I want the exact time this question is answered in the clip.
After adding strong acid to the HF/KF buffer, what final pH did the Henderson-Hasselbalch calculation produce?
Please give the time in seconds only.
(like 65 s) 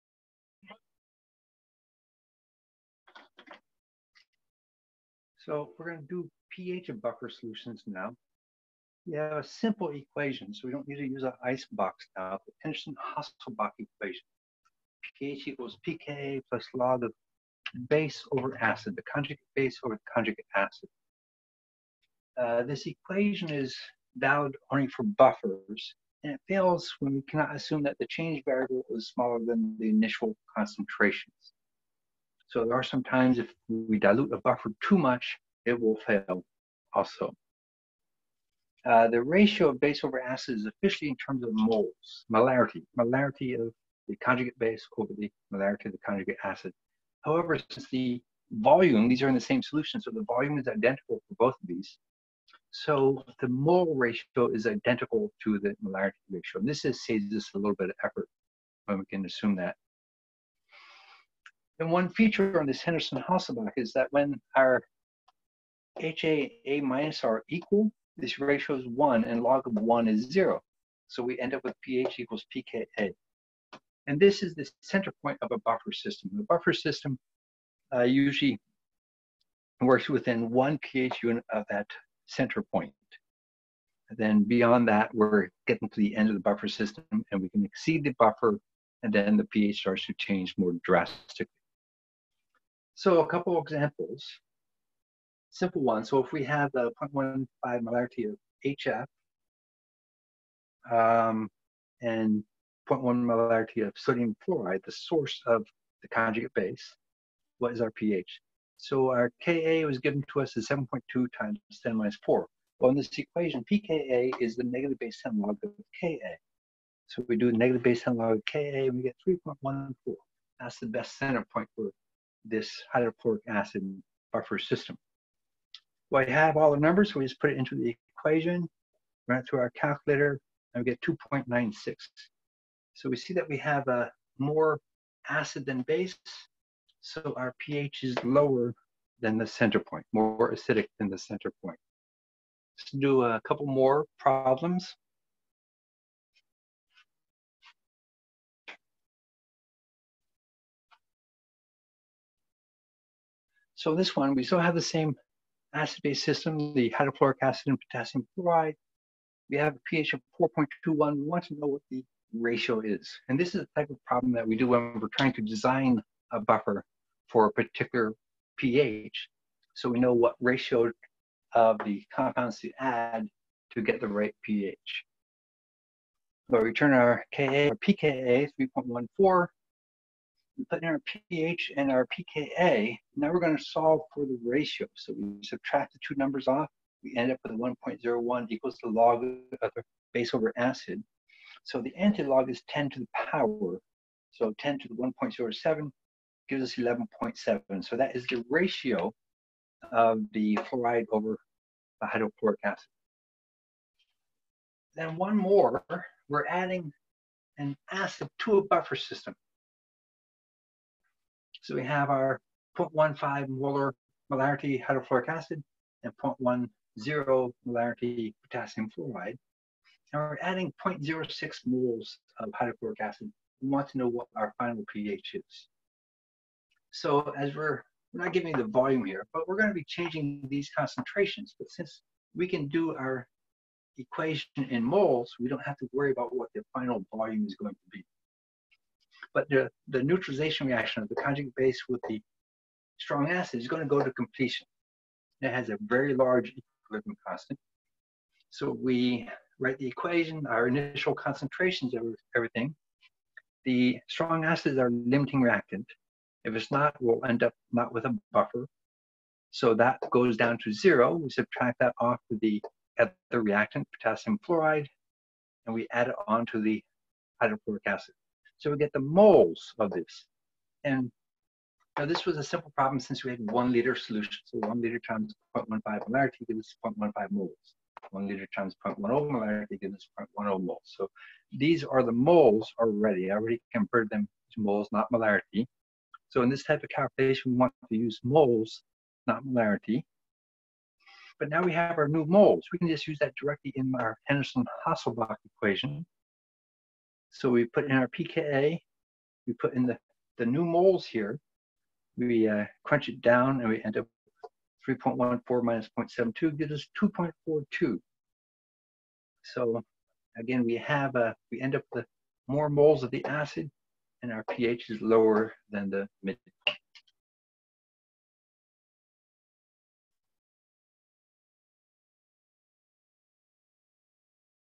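307 s.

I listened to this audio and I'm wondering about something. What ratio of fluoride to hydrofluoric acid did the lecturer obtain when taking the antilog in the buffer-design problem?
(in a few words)
11.7.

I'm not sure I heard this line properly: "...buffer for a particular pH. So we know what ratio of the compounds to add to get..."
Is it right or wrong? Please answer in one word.
right.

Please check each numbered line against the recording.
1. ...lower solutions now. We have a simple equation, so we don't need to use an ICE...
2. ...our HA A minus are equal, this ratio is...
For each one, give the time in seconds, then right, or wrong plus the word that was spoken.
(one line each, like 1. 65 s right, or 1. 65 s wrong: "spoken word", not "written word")
1. 7 s wrong: "buffer", not "lower"
2. 64 s right.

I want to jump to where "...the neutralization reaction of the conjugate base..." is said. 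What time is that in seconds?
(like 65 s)
239 s.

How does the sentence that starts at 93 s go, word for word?
So a couple examples, simple ones.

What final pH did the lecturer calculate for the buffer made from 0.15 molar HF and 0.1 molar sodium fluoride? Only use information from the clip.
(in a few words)
2.96.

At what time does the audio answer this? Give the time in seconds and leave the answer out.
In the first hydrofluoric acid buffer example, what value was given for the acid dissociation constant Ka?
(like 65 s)
110 s.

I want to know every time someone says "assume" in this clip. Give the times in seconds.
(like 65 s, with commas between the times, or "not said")
27 s, 59 s.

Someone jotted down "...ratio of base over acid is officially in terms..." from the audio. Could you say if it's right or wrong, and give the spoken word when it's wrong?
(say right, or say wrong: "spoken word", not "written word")
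right.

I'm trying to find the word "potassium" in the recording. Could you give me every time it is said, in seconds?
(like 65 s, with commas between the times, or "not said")
157 s, 218 s, 263 s.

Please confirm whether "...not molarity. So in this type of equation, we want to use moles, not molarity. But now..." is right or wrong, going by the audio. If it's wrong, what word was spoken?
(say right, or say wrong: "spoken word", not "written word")
wrong: "calculation", not "equation".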